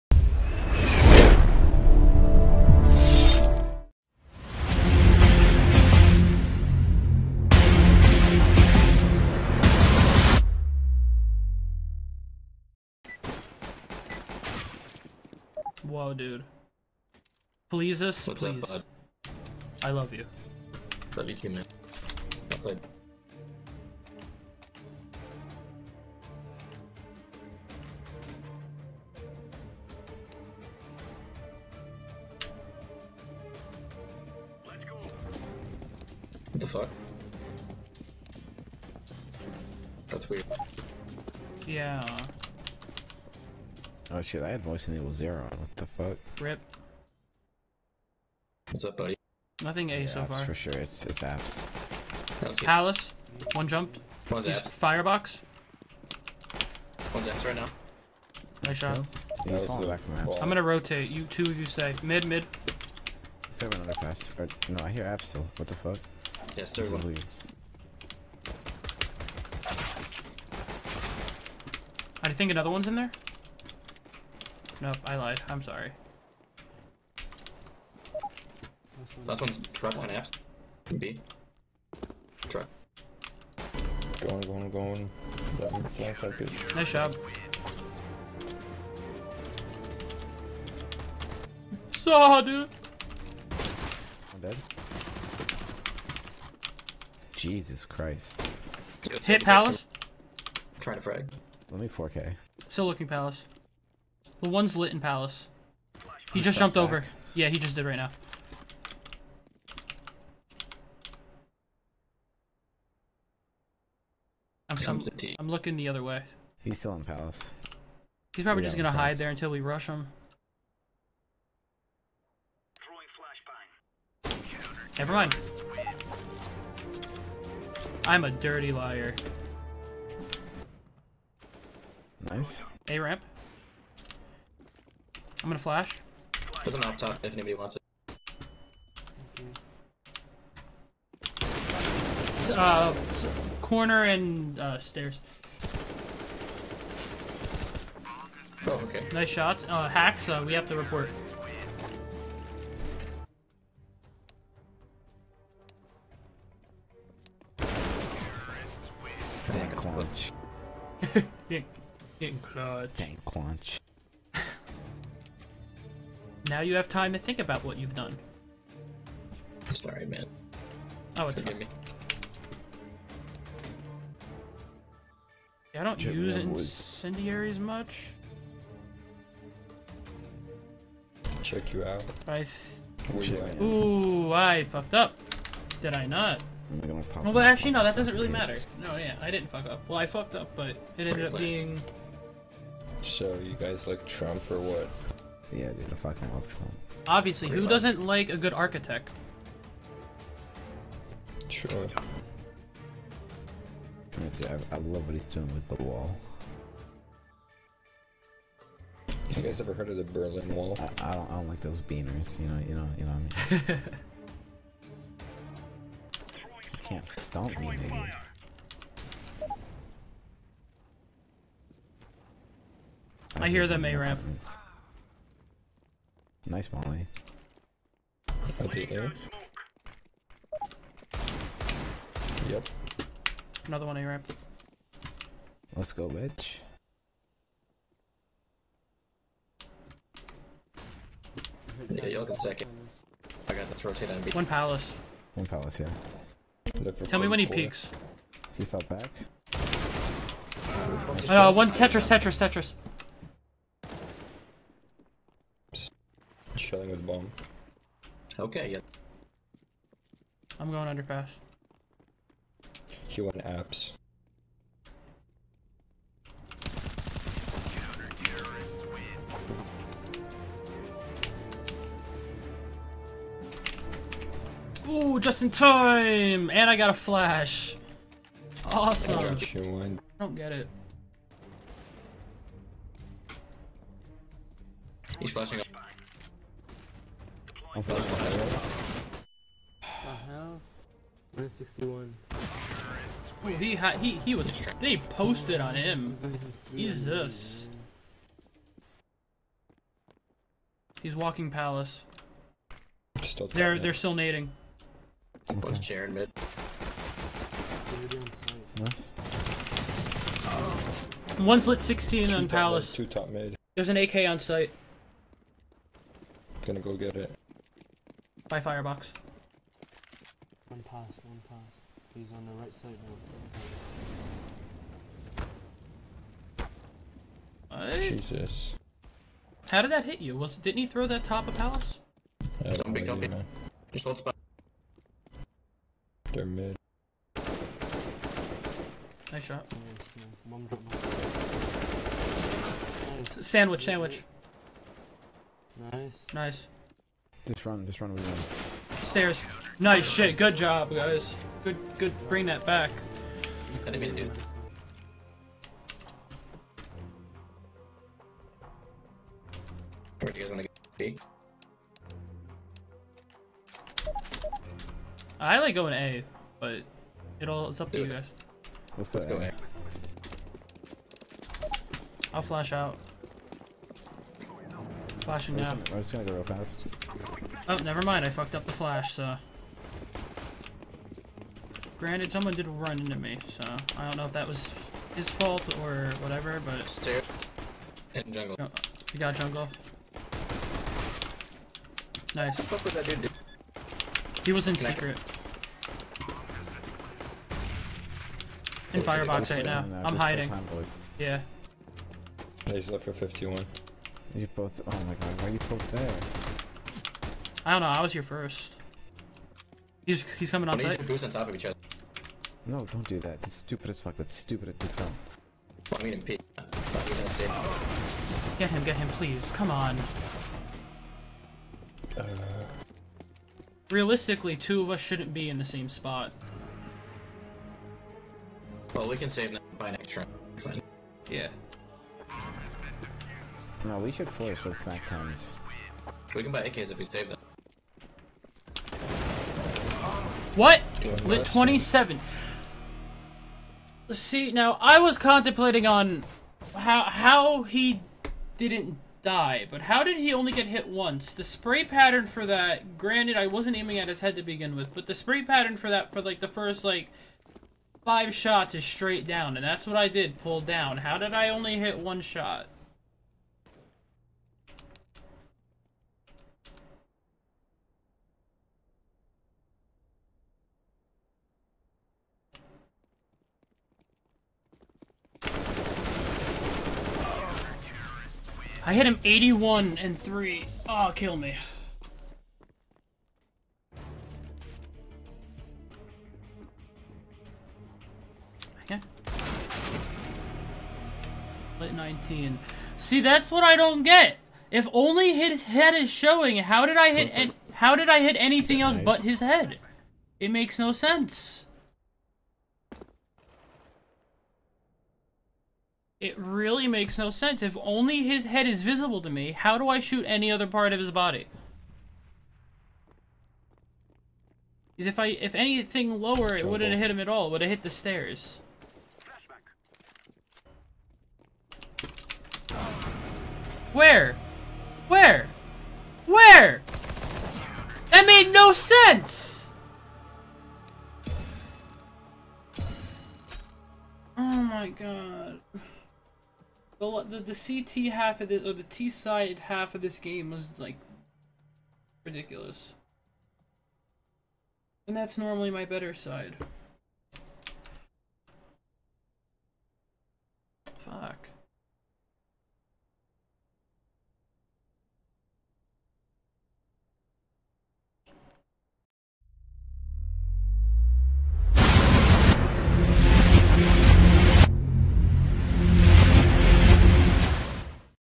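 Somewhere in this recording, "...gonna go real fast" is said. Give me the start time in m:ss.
6:16.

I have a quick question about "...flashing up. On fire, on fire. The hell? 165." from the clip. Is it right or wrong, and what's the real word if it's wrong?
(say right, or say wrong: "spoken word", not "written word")
wrong: "161", not "165".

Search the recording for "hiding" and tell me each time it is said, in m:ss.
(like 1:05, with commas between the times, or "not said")
6:40.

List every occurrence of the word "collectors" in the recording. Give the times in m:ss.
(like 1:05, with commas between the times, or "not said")
not said.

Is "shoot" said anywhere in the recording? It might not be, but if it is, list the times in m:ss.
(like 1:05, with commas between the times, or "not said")
8:29.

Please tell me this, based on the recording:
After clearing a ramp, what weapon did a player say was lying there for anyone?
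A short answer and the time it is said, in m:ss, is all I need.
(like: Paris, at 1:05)
op, at 2:16.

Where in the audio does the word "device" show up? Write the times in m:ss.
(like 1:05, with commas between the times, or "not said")
not said.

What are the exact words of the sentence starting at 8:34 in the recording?
Because if I if anything lower, it wouldn't have hit him at all.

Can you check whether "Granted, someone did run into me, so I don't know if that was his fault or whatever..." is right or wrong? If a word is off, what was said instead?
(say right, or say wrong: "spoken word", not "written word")
right.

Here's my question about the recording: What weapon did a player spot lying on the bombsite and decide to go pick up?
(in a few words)
AK.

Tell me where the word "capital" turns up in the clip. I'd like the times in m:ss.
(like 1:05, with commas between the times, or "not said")
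not said.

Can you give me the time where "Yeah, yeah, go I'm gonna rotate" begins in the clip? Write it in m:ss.
0:59.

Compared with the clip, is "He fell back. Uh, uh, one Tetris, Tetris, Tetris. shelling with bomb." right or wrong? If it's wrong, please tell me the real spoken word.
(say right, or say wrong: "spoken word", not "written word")
right.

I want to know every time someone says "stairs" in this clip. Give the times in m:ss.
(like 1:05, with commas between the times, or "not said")
2:24, 5:48, 6:26, 8:37.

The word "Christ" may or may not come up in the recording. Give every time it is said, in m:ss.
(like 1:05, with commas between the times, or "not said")
1:37.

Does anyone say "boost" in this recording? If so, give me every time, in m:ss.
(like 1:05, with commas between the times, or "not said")
6:51.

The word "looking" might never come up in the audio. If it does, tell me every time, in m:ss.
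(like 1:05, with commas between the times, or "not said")
1:42, 1:55.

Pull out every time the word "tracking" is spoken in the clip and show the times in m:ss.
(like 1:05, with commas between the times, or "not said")
not said.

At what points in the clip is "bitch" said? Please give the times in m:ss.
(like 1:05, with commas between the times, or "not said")
3:56.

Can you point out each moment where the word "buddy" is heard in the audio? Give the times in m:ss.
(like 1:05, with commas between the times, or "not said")
0:48.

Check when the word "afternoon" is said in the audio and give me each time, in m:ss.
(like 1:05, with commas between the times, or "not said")
not said.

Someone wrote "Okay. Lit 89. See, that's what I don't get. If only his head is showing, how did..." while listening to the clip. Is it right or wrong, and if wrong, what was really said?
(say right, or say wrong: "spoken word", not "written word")
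wrong: "19", not "89".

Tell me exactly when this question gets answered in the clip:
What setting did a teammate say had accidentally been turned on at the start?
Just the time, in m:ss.
0:44.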